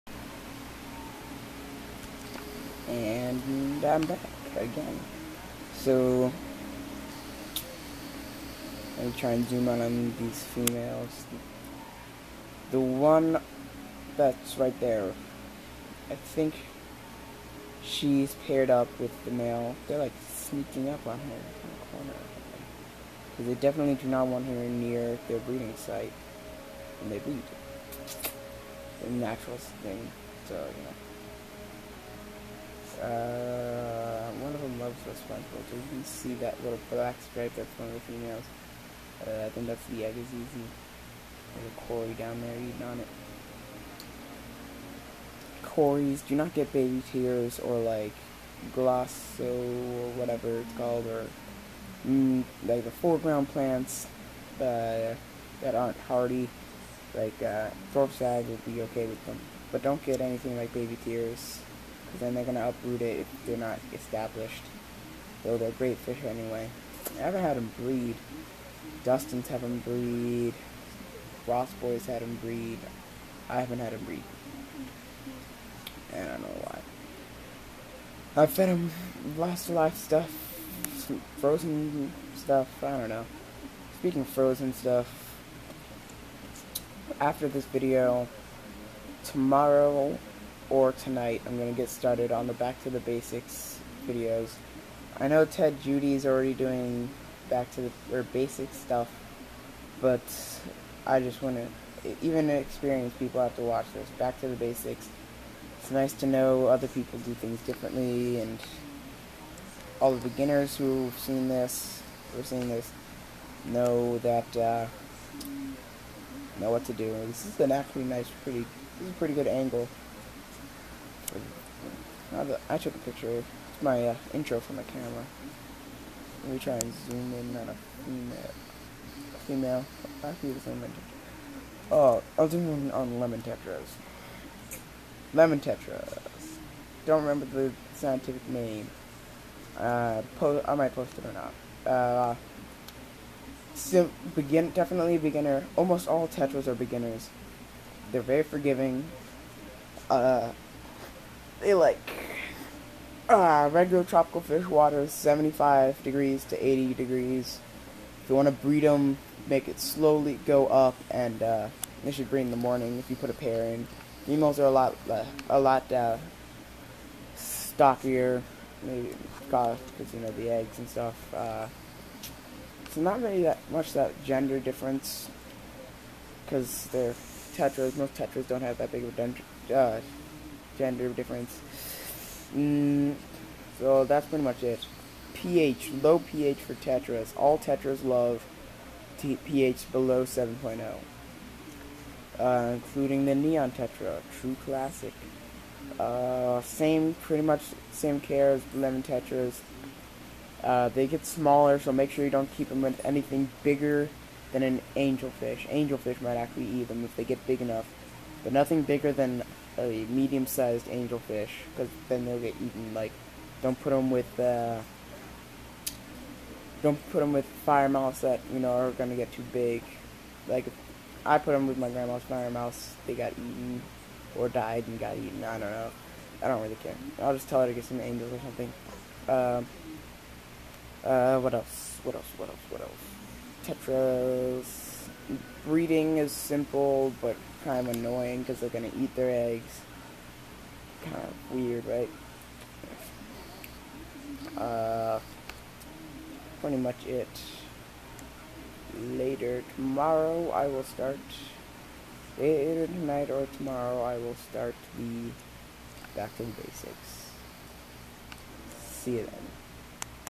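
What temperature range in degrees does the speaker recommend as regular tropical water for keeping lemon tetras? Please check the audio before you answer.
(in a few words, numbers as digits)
75 to 80 degrees.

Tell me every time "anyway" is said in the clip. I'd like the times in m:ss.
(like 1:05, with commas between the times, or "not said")
1:06.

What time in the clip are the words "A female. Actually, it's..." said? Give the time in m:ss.
2:09.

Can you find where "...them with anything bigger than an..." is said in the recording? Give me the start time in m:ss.
3:22.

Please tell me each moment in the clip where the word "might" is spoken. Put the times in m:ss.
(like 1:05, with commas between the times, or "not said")
2:20, 3:26.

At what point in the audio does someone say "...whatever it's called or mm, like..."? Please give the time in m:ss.
0:50.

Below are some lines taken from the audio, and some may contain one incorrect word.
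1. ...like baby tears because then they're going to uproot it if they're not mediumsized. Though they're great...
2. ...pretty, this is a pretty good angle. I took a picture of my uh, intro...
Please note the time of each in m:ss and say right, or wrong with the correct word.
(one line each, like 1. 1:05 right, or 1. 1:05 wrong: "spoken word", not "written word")
1. 1:00 wrong: "established", not "mediumsized"
2. 1:58 right.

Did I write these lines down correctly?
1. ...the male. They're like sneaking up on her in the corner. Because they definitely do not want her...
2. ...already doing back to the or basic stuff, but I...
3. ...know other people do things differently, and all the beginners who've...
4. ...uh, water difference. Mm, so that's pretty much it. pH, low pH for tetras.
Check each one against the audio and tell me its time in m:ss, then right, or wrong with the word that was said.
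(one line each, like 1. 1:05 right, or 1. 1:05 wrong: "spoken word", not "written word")
1. 0:19 right
2. 1:36 right
3. 1:46 right
4. 2:59 wrong: "gender", not "water".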